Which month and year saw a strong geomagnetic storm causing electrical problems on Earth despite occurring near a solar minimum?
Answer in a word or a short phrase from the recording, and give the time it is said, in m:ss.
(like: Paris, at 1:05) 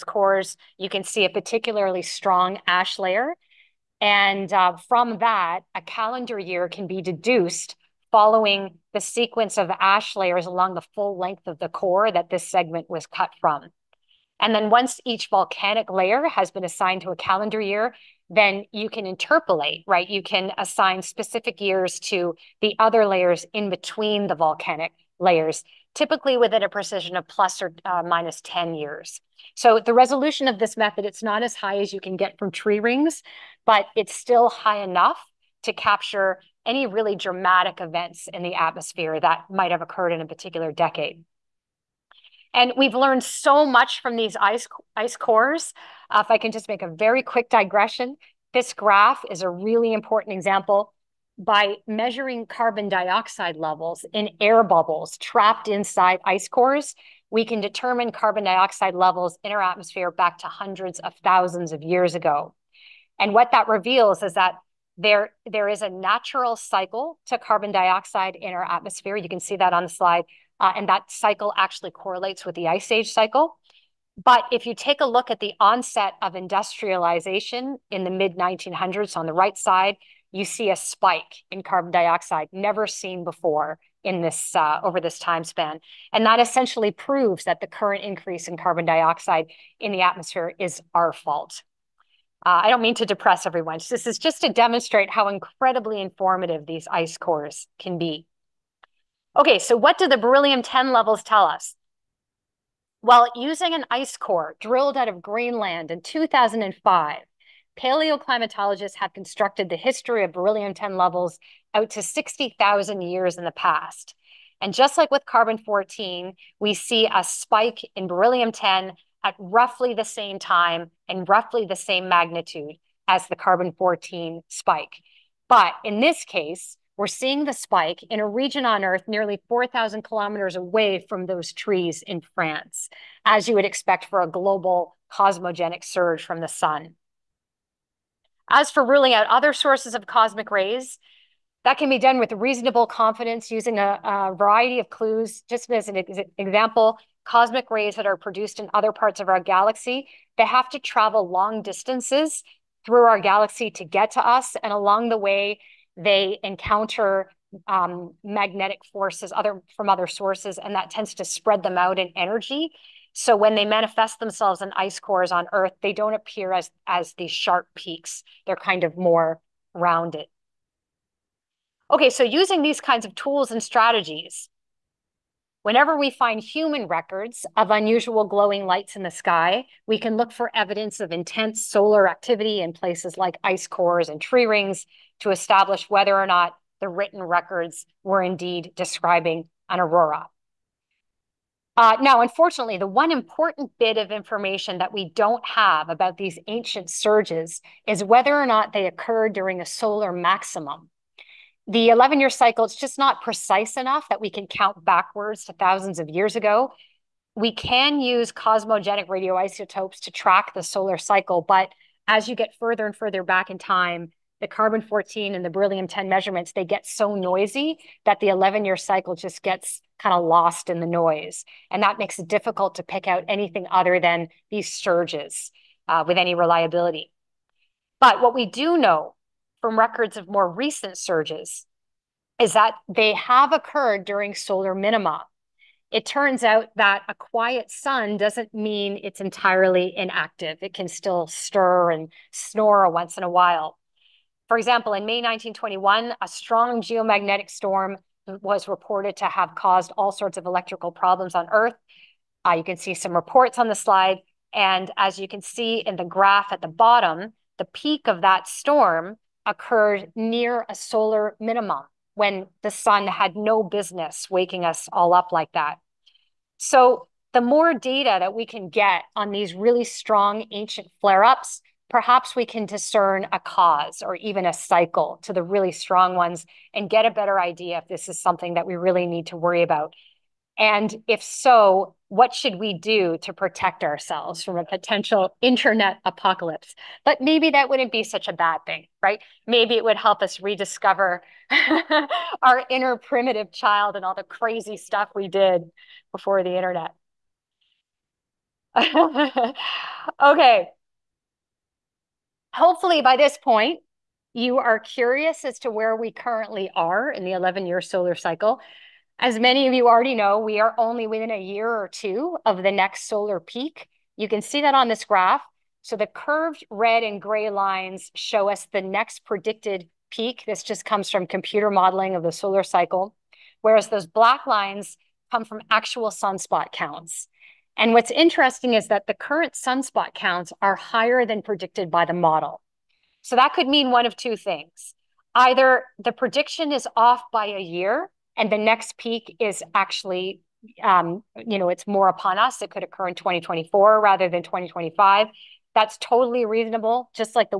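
May 1921, at 4:05.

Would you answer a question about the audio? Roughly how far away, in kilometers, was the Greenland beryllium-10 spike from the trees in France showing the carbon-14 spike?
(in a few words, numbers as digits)
4,000 kilometers.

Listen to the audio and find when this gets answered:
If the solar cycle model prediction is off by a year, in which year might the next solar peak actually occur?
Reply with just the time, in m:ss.
5:43.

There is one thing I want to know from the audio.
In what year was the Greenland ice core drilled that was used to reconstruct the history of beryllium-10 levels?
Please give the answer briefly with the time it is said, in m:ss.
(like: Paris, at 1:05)
2005, at 1:46.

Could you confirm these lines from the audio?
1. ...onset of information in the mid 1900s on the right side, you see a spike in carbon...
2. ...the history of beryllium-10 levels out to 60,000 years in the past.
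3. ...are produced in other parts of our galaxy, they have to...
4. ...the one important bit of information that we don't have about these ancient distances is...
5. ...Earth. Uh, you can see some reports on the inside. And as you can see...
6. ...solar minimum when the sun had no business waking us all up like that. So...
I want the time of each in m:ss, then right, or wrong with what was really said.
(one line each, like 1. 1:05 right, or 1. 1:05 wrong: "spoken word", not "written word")
1. 1:15 wrong: "industrialization", not "information"
2. 1:49 right
3. 2:28 right
4. 3:12 wrong: "surges", not "distances"
5. 4:11 wrong: "slide", not "inside"
6. 4:20 right.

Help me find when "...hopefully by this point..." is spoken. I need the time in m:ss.
5:02.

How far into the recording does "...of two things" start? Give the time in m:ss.
5:34.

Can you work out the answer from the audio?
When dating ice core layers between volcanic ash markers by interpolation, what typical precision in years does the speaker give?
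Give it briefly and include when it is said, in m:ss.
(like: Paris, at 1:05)
plus or minus 10 years, at 0:27.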